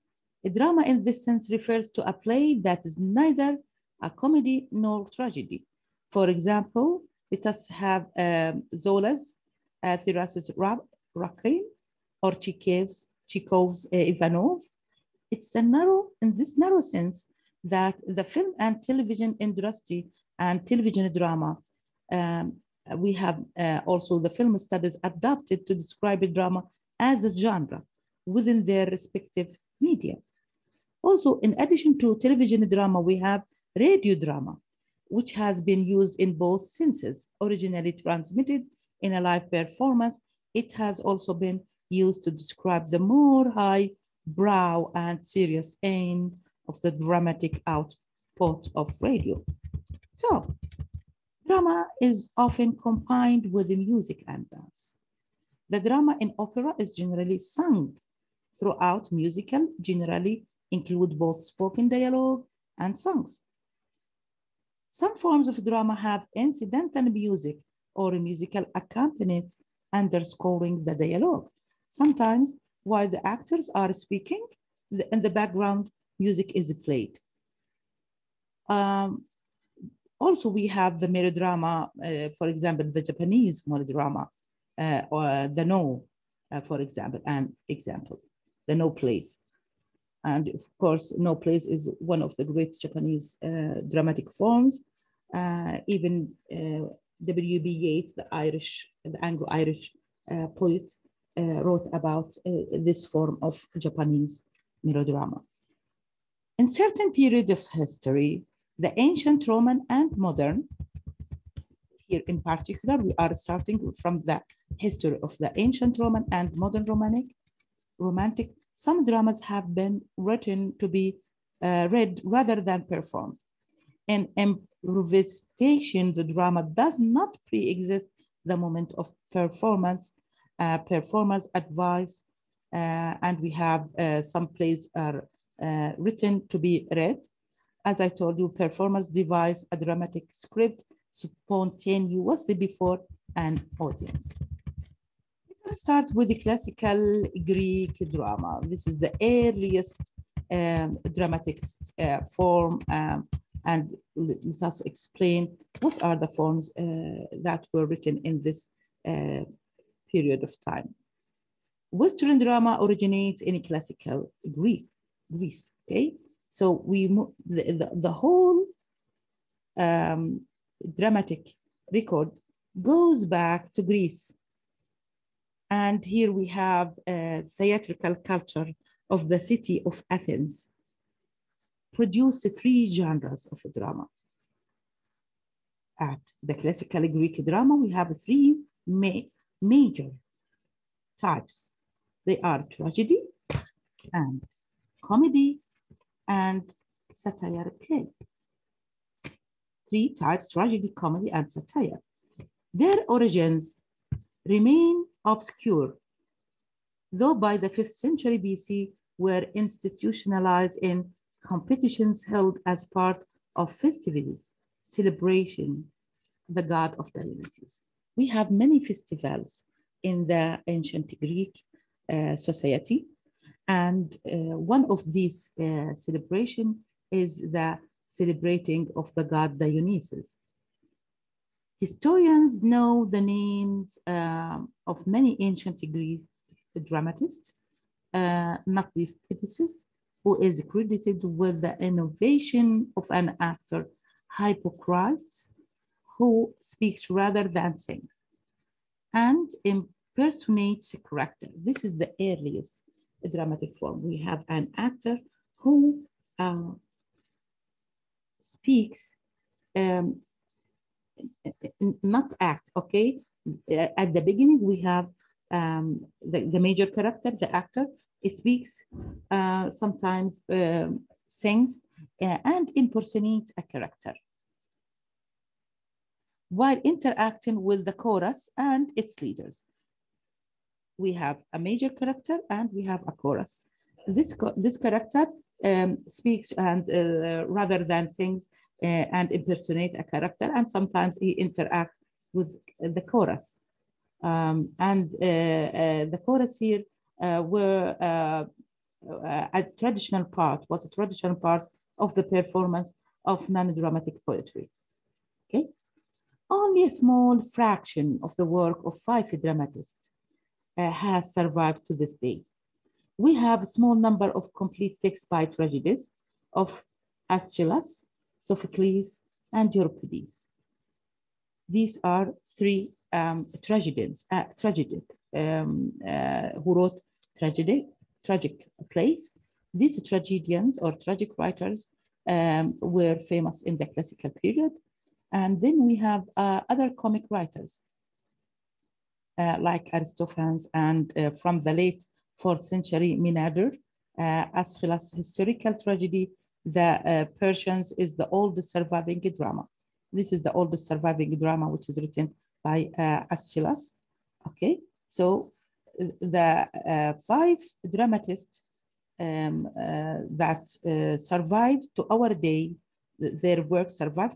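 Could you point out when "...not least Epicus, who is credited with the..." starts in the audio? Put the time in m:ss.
3:58.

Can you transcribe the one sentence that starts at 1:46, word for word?
In certain period of history, the ancient Roman and modern.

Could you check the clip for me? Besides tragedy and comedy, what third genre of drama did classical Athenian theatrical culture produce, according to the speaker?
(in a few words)
Satire play.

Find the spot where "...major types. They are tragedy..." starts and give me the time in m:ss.
3:09.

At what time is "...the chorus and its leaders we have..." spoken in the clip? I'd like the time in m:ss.
4:37.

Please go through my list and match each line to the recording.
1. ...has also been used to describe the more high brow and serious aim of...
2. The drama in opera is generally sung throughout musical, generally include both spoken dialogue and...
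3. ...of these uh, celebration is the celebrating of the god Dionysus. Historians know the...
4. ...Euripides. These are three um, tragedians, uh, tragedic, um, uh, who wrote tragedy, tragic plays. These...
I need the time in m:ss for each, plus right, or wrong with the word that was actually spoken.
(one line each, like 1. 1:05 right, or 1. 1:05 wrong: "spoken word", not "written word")
1. 0:40 right
2. 0:55 right
3. 3:44 right
4. 5:19 right.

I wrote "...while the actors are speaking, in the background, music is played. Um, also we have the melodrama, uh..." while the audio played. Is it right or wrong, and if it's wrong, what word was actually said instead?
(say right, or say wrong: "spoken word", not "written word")
right.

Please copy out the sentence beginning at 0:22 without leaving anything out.
Um, we have uh, also the film studies adapted to describe drama as a genre within their respective media.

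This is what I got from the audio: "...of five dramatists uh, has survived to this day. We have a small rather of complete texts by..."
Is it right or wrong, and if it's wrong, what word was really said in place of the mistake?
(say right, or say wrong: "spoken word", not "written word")
wrong: "number", not "rather".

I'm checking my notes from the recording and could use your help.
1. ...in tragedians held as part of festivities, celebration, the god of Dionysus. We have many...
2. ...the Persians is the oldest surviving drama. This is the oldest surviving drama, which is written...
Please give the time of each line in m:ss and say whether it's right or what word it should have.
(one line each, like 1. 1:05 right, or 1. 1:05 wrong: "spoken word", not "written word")
1. 3:30 wrong: "competitions", not "tragedians"
2. 5:46 right.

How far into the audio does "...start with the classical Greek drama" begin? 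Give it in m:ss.
2:25.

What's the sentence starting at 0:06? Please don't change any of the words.
For example, it does have um, Zola's uh, Thérèse's or Chekhov's, Chekhov's uh, Ivanov.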